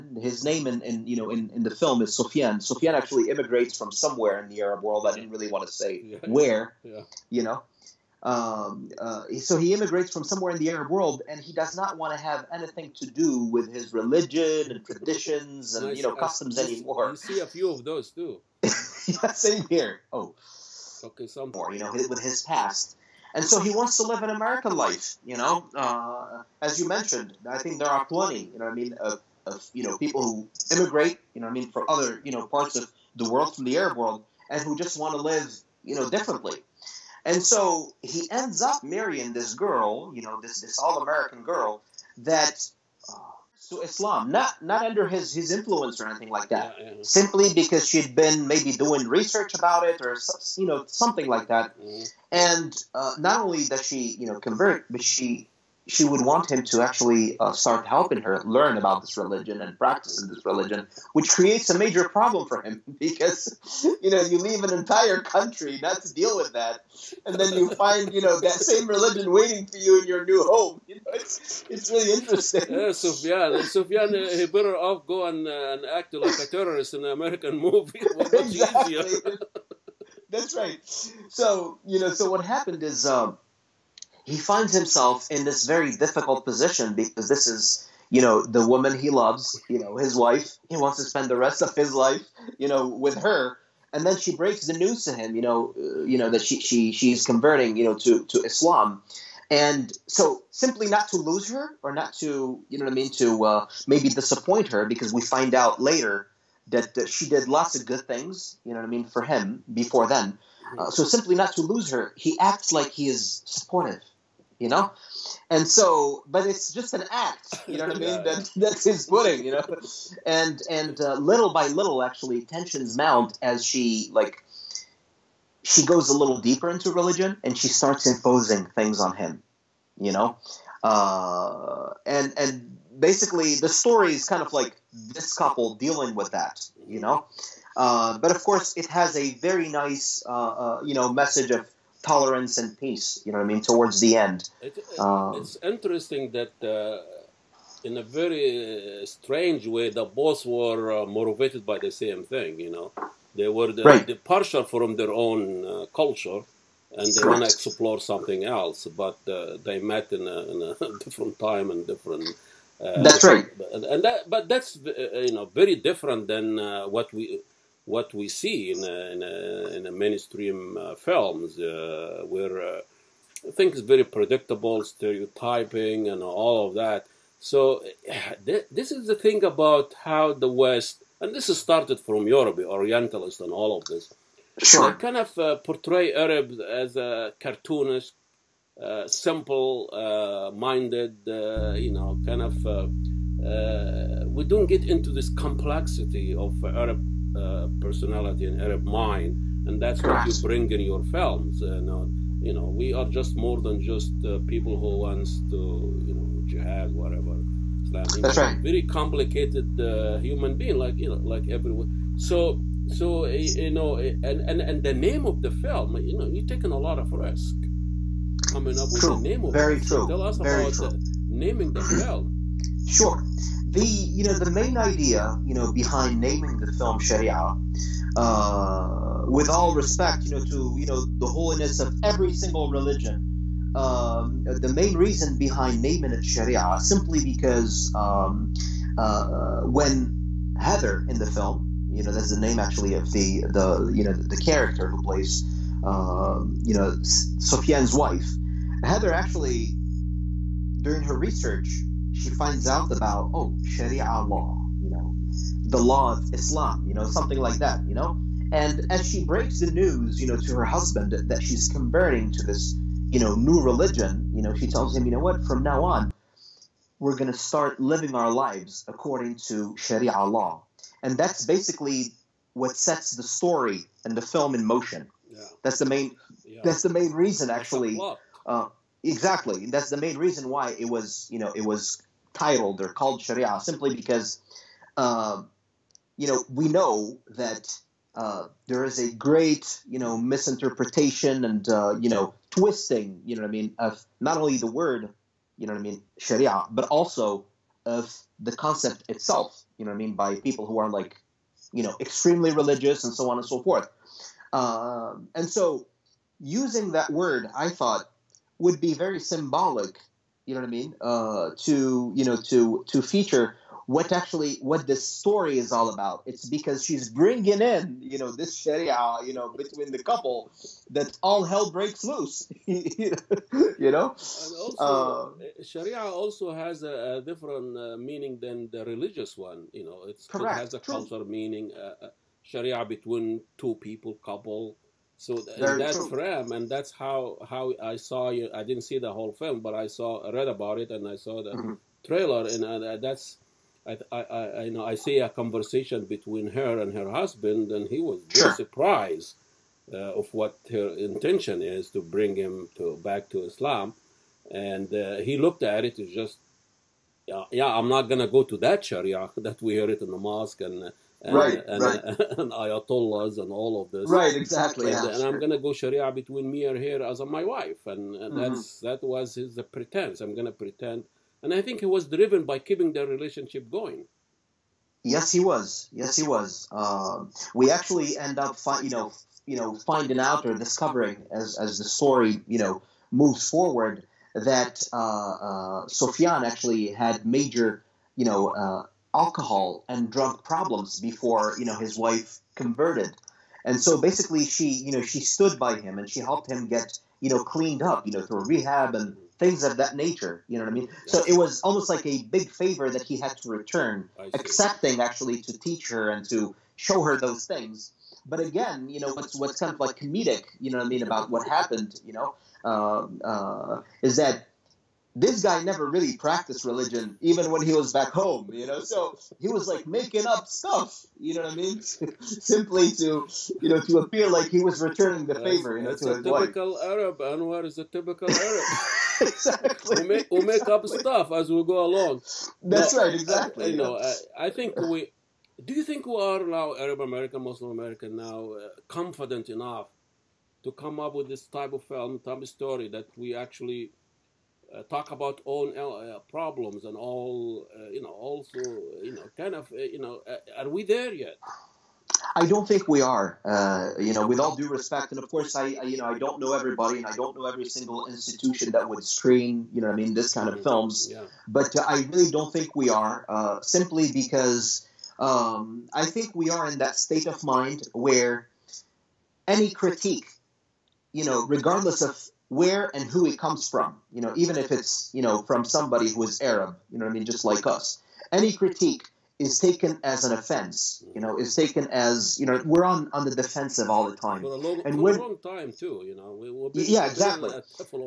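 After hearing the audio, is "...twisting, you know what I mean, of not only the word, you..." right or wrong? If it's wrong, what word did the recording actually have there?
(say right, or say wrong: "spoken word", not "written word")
right.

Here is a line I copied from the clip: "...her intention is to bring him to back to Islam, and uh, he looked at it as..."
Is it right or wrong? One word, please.
right.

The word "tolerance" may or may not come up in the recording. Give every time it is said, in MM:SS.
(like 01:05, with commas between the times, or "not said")
02:22.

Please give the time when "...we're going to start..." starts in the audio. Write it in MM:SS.
04:26.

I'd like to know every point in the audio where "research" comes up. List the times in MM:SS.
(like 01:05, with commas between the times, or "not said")
00:49, 04:11.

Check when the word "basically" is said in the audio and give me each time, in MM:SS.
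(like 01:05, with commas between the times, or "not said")
02:12, 04:31, 06:33.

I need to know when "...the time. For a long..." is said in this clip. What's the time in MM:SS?
08:04.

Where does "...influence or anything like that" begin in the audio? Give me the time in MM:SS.
00:45.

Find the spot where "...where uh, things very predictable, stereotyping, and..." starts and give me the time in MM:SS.
02:52.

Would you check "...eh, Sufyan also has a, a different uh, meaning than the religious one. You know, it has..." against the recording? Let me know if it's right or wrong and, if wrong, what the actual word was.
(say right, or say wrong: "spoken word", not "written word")
wrong: "Sharia", not "Sufyan".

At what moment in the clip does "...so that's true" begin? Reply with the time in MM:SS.
05:35.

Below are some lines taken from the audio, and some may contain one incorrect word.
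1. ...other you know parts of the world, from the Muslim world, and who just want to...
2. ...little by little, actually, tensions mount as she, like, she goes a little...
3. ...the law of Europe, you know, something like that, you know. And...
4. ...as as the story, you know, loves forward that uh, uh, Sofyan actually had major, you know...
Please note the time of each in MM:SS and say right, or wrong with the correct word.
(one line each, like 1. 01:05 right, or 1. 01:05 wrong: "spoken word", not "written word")
1. 00:31 wrong: "Arab", not "Muslim"
2. 02:01 right
3. 04:15 wrong: "Islam", not "Europe"
4. 06:21 wrong: "moves", not "loves".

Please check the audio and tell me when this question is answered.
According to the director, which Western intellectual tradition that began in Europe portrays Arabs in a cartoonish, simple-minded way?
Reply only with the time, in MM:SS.
03:02.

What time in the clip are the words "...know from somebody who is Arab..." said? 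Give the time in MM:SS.
07:55.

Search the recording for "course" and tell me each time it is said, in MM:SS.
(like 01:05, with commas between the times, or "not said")
02:18, 07:35.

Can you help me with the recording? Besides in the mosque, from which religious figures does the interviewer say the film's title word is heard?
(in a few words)
ayatollahs.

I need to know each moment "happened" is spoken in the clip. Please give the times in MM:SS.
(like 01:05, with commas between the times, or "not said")
01:22, 06:51.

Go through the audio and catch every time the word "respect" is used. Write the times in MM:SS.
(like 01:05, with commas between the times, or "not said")
03:49, 07:34.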